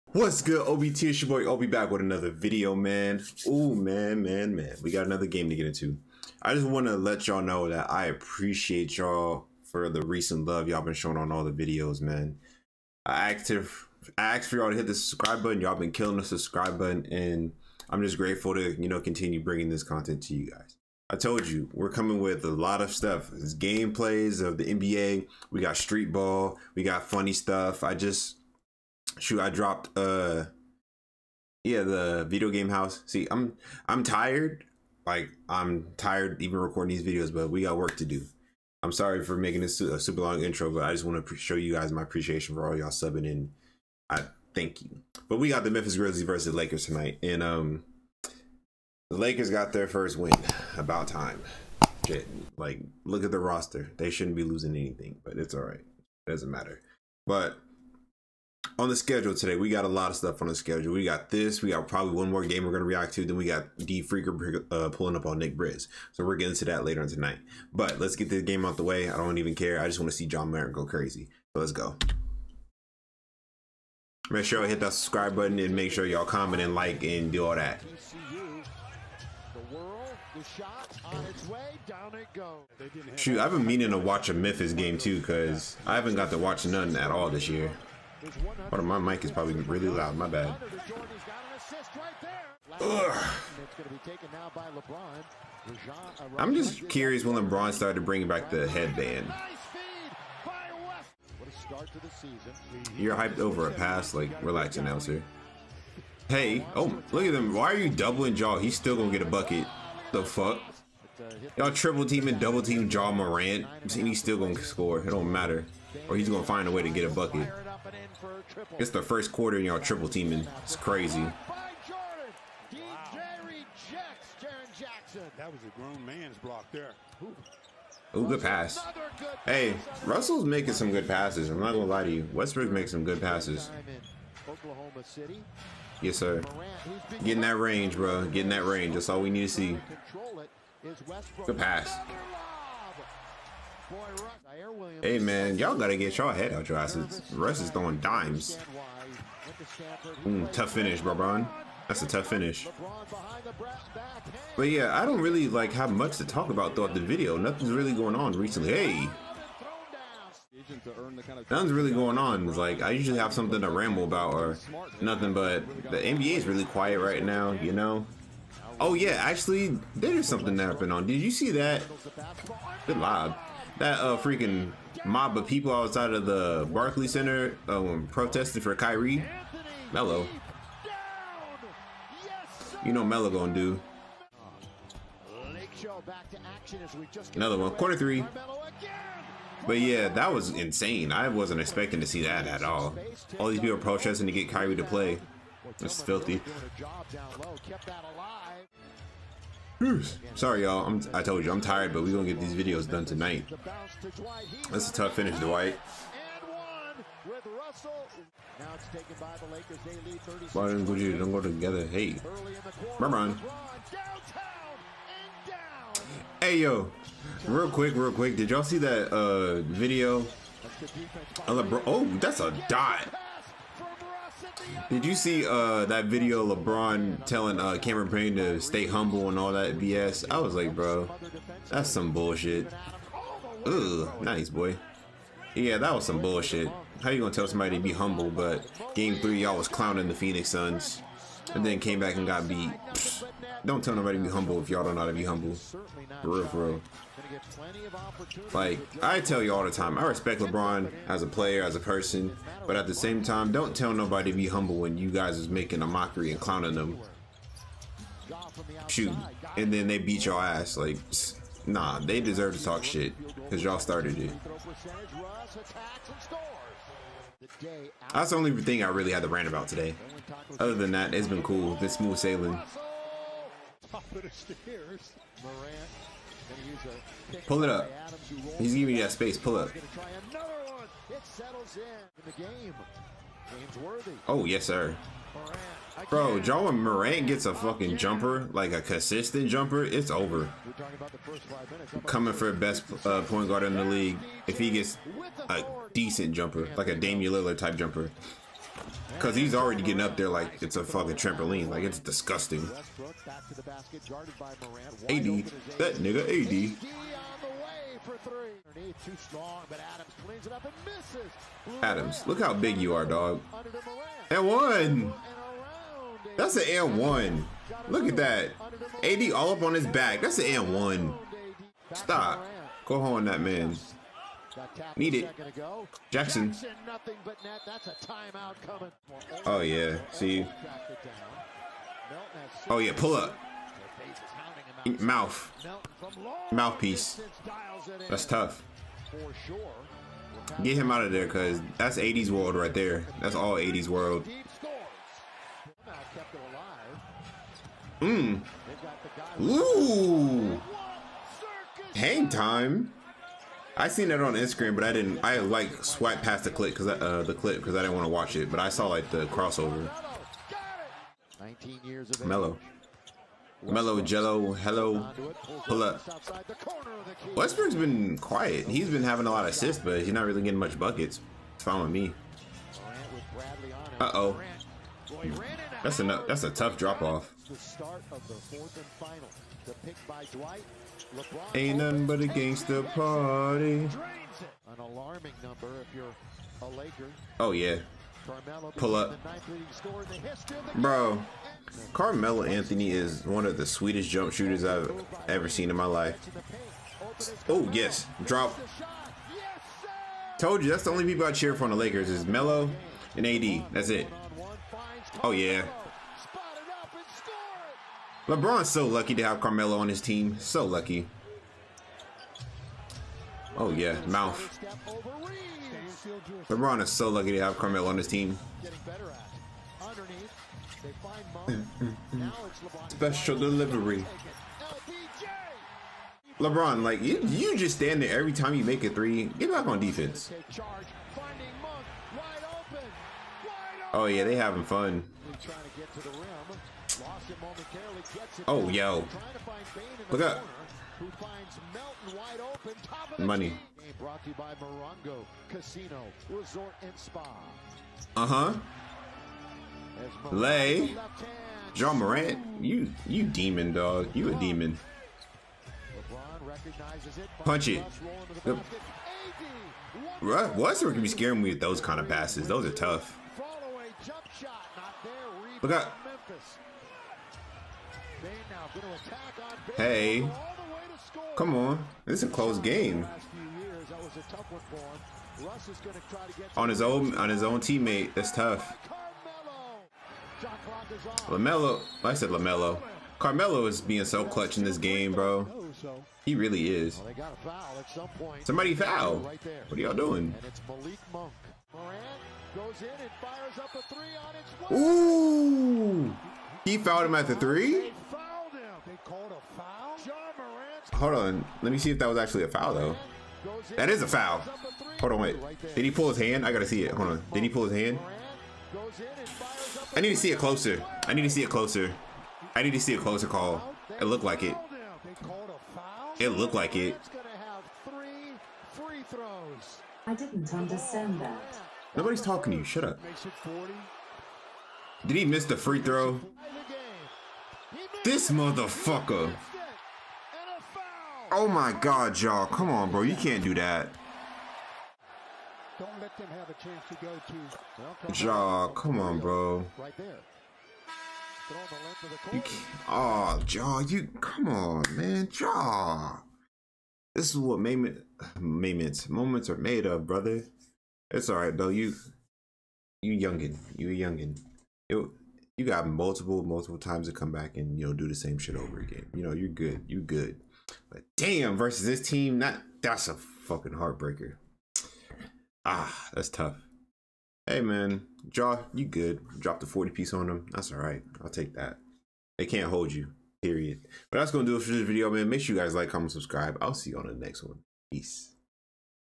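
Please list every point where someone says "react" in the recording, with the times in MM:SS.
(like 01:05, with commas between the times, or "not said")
01:02.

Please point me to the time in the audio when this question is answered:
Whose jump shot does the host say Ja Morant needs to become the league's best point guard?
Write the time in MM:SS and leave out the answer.
04:56.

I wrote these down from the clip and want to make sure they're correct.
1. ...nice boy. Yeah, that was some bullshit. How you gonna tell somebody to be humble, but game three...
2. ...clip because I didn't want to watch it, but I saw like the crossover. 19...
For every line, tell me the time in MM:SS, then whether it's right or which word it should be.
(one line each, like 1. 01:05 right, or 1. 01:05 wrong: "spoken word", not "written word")
1. 03:54 right
2. 05:57 right.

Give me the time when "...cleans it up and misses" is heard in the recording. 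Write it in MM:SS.
05:10.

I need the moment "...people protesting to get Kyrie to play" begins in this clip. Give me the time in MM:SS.
03:13.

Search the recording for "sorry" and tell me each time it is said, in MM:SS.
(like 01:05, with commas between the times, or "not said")
00:38, 03:20.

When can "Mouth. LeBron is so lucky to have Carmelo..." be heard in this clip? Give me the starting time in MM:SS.
06:54.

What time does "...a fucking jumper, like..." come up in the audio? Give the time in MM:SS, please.
04:47.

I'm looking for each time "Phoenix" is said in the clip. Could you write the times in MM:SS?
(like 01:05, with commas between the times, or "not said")
04:00.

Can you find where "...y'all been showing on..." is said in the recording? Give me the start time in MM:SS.
00:10.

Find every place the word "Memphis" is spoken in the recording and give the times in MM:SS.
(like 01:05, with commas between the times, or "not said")
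00:45, 01:24.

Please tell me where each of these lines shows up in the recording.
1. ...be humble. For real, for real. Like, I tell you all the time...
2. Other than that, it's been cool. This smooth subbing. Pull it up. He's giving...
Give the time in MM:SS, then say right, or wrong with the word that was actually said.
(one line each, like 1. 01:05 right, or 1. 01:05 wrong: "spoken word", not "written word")
1. 04:05 right
2. 04:30 wrong: "sailing", not "subbing".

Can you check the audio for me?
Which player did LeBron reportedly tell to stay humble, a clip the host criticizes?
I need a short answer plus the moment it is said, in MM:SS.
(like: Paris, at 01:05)
Cameron Payne, at 03:47.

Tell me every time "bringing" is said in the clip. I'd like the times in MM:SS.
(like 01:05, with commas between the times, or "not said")
00:19, 01:38.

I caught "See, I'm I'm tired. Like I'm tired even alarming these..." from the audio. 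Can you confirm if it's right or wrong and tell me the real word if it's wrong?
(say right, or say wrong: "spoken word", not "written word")
wrong: "recording", not "alarming".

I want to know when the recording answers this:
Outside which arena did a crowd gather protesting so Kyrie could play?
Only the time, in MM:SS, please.
02:56.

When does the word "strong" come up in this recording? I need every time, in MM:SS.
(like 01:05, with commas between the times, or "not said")
05:09.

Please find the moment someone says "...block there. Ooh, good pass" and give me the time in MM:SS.
02:06.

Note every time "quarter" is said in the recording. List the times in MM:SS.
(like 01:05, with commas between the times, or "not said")
01:59, 03:07.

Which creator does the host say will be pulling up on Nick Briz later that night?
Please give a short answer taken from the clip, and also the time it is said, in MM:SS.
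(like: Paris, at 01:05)
D Freaker, at 01:03.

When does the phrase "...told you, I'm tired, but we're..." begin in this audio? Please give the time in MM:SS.
03:21.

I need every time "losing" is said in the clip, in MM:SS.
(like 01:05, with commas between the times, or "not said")
00:54.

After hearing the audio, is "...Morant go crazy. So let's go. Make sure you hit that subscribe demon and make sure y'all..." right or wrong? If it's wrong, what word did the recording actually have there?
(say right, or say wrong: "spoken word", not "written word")
wrong: "button", not "demon".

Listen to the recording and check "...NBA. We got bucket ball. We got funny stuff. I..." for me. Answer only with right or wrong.
wrong.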